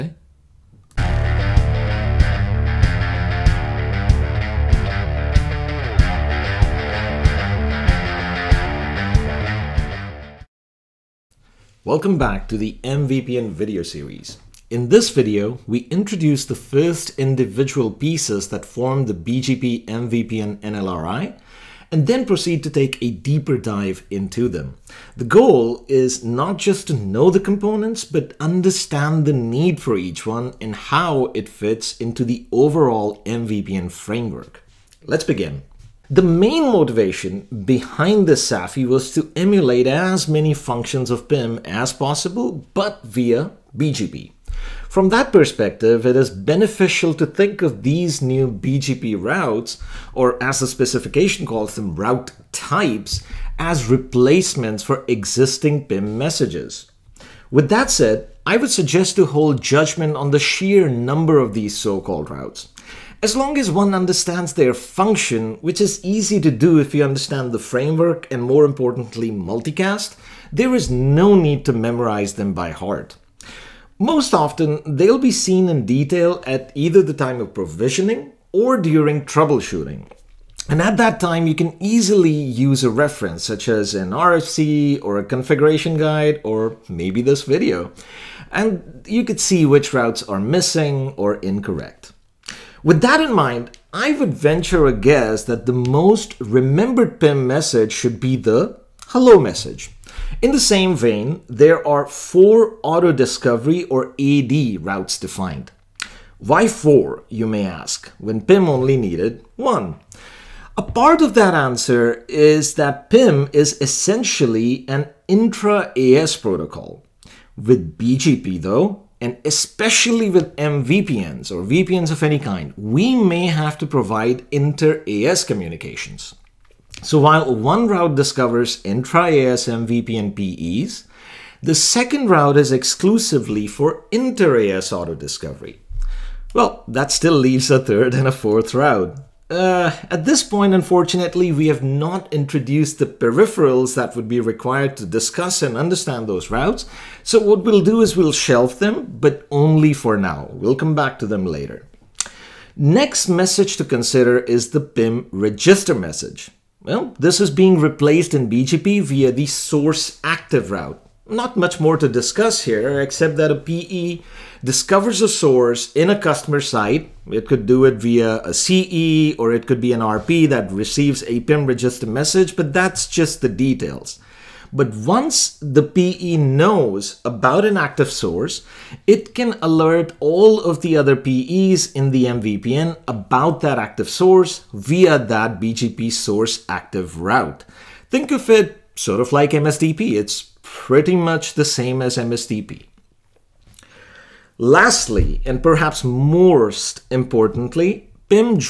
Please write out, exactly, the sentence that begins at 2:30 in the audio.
We'll come back to them later.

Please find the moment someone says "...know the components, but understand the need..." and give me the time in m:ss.
0:26.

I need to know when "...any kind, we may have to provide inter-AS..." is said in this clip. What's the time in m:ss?
2:02.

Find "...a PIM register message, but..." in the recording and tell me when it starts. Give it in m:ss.
2:51.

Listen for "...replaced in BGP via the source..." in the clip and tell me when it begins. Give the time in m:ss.
2:37.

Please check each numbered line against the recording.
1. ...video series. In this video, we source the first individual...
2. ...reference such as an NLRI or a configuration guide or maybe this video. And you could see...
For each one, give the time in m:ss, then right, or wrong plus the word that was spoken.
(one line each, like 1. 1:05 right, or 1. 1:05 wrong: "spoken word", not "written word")
1. 0:13 wrong: "introduce", not "source"
2. 1:22 wrong: "RFC", not "NLRI".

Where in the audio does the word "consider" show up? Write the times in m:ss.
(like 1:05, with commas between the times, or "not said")
2:33.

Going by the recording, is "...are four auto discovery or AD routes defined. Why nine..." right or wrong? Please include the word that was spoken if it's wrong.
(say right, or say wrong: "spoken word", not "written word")
wrong: "four", not "nine".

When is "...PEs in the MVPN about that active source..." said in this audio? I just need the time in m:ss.
3:01.